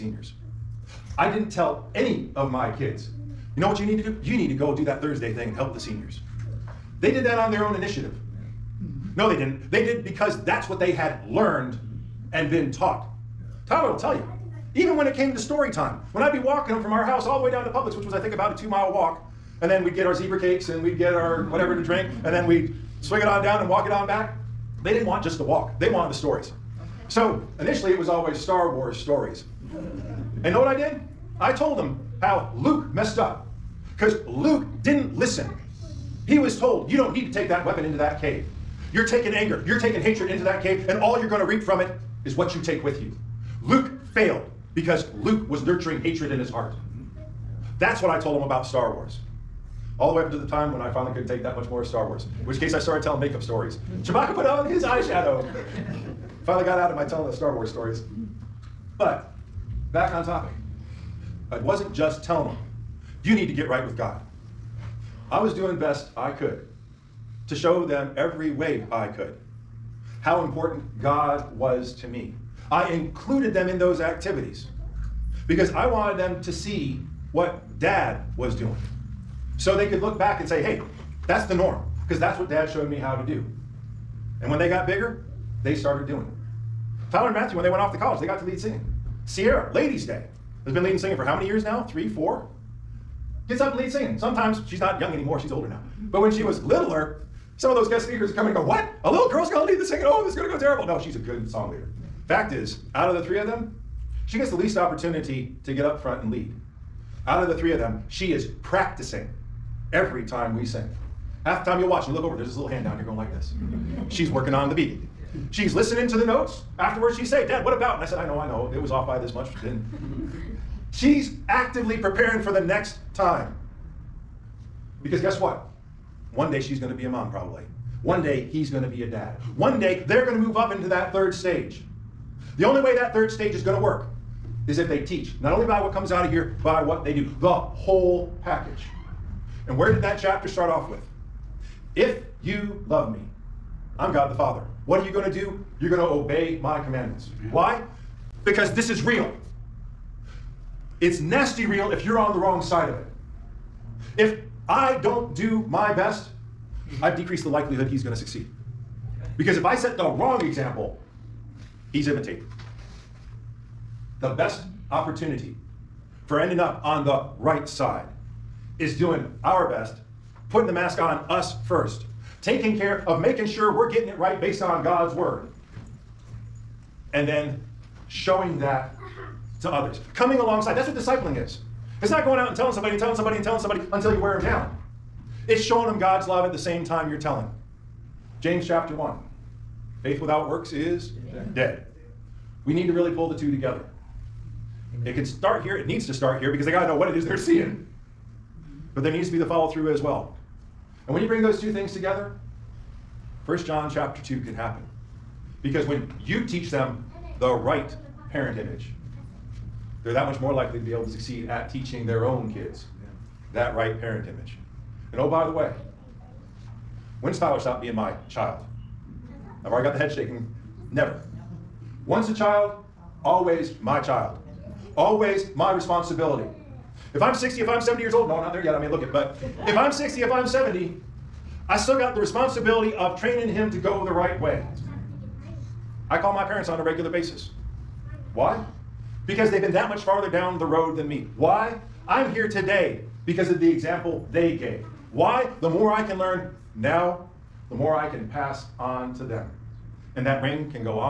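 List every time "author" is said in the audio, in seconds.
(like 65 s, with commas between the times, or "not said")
not said.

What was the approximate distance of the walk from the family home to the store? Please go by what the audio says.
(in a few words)
2 miles.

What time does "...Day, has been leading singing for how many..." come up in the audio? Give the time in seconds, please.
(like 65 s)
90 s.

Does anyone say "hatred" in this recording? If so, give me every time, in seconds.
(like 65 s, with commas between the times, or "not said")
40 s, 46 s.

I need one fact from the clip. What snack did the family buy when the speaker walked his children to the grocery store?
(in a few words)
zebra cakes.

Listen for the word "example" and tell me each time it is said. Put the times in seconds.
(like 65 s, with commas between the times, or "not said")
160 s, 243 s.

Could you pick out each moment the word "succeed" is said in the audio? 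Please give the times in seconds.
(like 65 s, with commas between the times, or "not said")
158 s, 211 s.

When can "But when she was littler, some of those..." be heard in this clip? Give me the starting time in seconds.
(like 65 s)
95 s.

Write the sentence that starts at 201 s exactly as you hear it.
And when you bring those two things together, 1 John chapter 2 can happen.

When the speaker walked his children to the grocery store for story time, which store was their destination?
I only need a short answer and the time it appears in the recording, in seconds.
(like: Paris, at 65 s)
Publix, at 17 s.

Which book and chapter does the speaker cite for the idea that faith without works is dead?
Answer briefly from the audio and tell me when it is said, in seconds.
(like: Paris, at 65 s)
James chapter 1, at 188 s.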